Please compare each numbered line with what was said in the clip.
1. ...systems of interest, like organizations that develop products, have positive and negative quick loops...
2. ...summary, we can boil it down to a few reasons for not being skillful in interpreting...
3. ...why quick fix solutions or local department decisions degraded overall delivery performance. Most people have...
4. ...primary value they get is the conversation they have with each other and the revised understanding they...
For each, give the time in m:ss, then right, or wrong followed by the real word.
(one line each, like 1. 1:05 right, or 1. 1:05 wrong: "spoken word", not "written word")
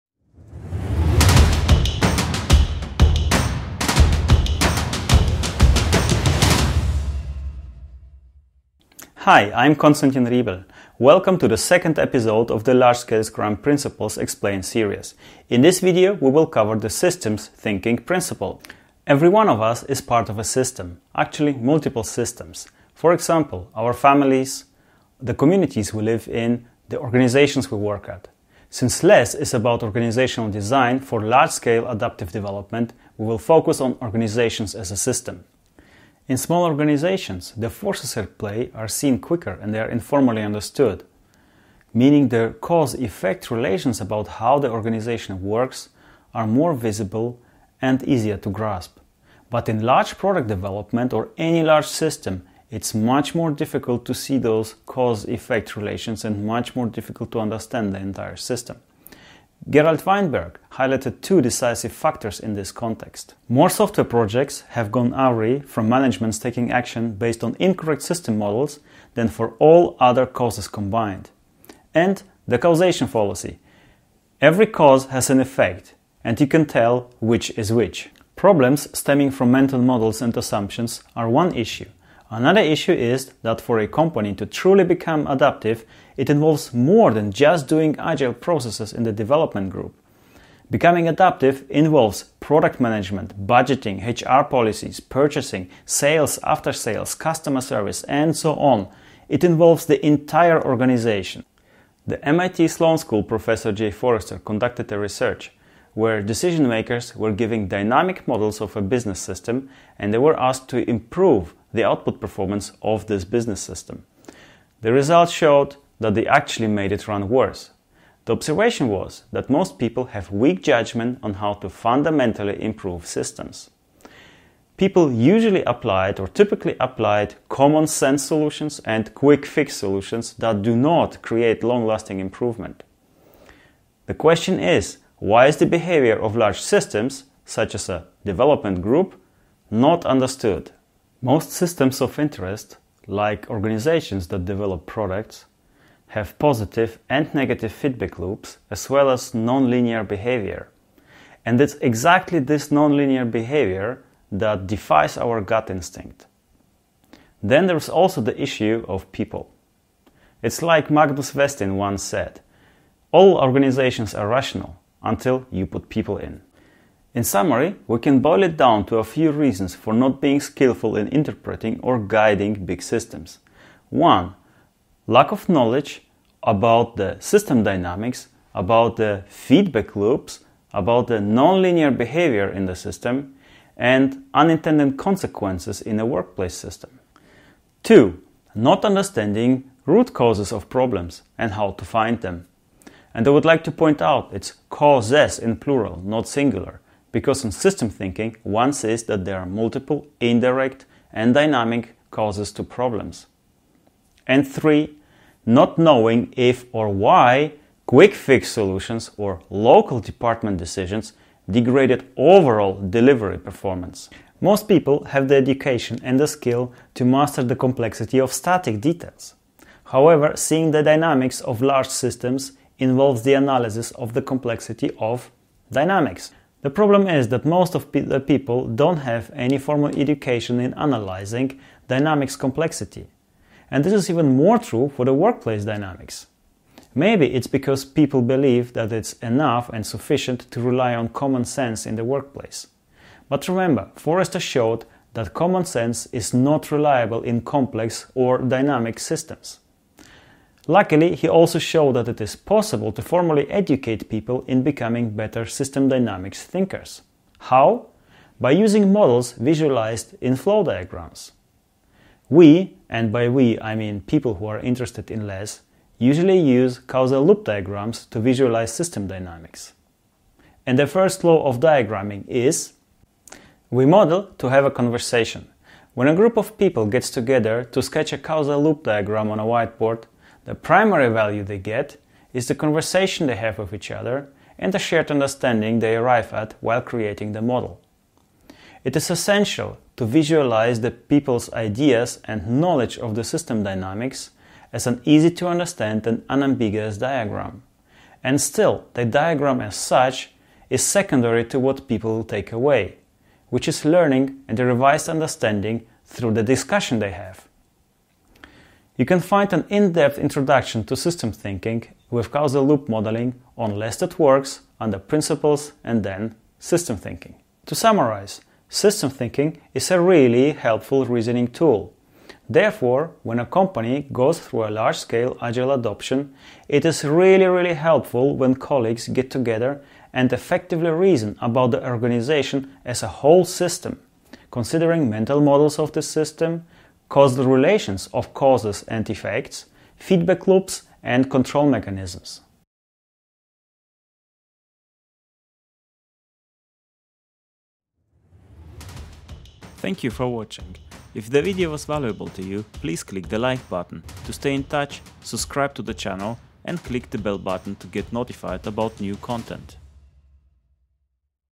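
1. 2:21 wrong: "feedback", not "quick"
2. 2:47 right
3. 3:26 right
4. 4:40 wrong: "shared", not "revised".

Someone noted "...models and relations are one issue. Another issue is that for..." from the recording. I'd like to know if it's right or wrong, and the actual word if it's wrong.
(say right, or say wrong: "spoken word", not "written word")
wrong: "assumptions", not "relations".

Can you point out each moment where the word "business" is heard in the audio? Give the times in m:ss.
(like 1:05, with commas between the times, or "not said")
1:48, 1:53.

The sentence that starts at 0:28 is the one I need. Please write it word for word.
Since LeSS is about organizational design for large scale adaptive development, we will focus on organizations as a system.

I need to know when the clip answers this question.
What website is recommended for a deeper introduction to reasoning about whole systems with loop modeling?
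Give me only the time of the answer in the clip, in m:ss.
5:13.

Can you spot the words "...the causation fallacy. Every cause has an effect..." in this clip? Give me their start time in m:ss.
1:12.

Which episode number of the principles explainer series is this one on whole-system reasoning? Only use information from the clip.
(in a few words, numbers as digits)
2.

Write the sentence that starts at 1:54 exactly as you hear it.
The results showed that they actually made it run worse.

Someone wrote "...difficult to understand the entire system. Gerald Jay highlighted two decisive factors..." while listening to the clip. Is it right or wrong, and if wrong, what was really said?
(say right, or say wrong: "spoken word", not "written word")
wrong: "Weinberg", not "Jay".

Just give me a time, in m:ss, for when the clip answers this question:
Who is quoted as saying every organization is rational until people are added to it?
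2:40.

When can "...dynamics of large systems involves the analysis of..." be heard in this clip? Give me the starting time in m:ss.
3:40.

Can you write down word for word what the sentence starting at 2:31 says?
And it's exactly this nonlinear behavior that defies our gut instinct.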